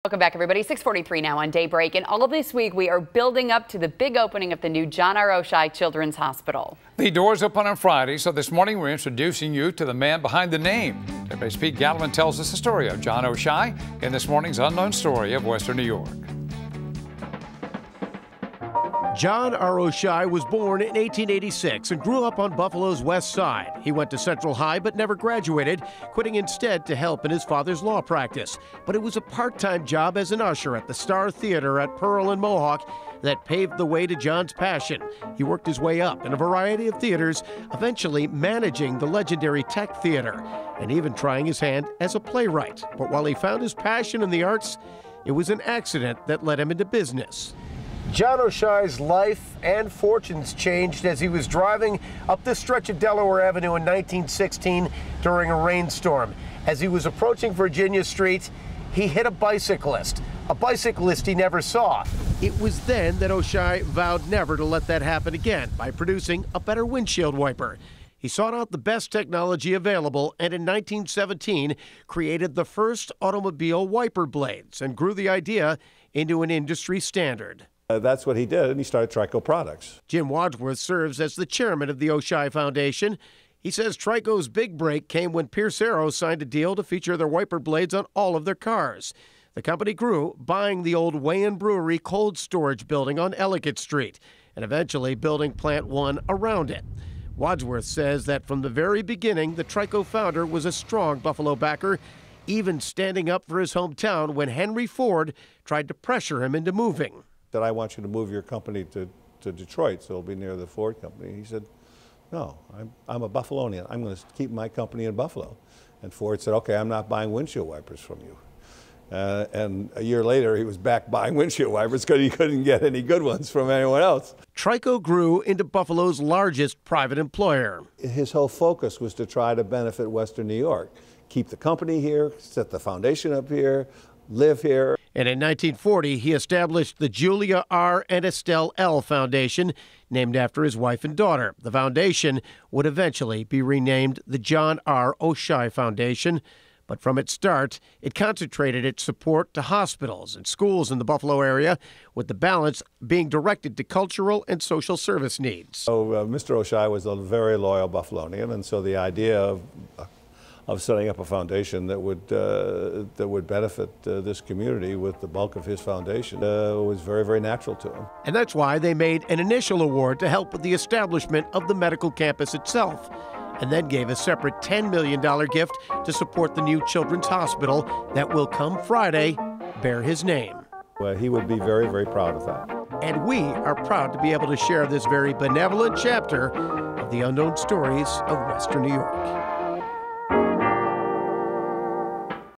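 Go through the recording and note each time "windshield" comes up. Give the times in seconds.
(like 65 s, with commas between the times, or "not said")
66 s, 117 s, 121 s.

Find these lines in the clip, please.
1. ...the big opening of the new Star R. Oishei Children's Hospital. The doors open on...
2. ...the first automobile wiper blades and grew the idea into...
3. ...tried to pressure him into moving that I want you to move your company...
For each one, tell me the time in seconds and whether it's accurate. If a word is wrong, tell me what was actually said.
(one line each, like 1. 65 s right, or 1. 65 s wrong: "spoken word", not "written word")
1. 3 s wrong: "John", not "Star"
2. 72 s right
3. 105 s right.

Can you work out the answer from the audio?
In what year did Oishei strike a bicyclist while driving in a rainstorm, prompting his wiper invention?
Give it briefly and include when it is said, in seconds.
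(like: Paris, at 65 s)
1916, at 53 s.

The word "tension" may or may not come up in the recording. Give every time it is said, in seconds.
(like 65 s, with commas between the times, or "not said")
not said.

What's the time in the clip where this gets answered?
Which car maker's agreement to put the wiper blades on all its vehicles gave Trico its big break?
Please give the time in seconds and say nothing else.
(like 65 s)
85 s.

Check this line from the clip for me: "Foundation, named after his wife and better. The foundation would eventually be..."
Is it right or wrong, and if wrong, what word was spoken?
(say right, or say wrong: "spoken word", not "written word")
wrong: "daughter", not "better".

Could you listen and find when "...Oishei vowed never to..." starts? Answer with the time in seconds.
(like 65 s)
63 s.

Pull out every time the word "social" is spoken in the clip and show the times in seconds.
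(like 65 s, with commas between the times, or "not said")
154 s.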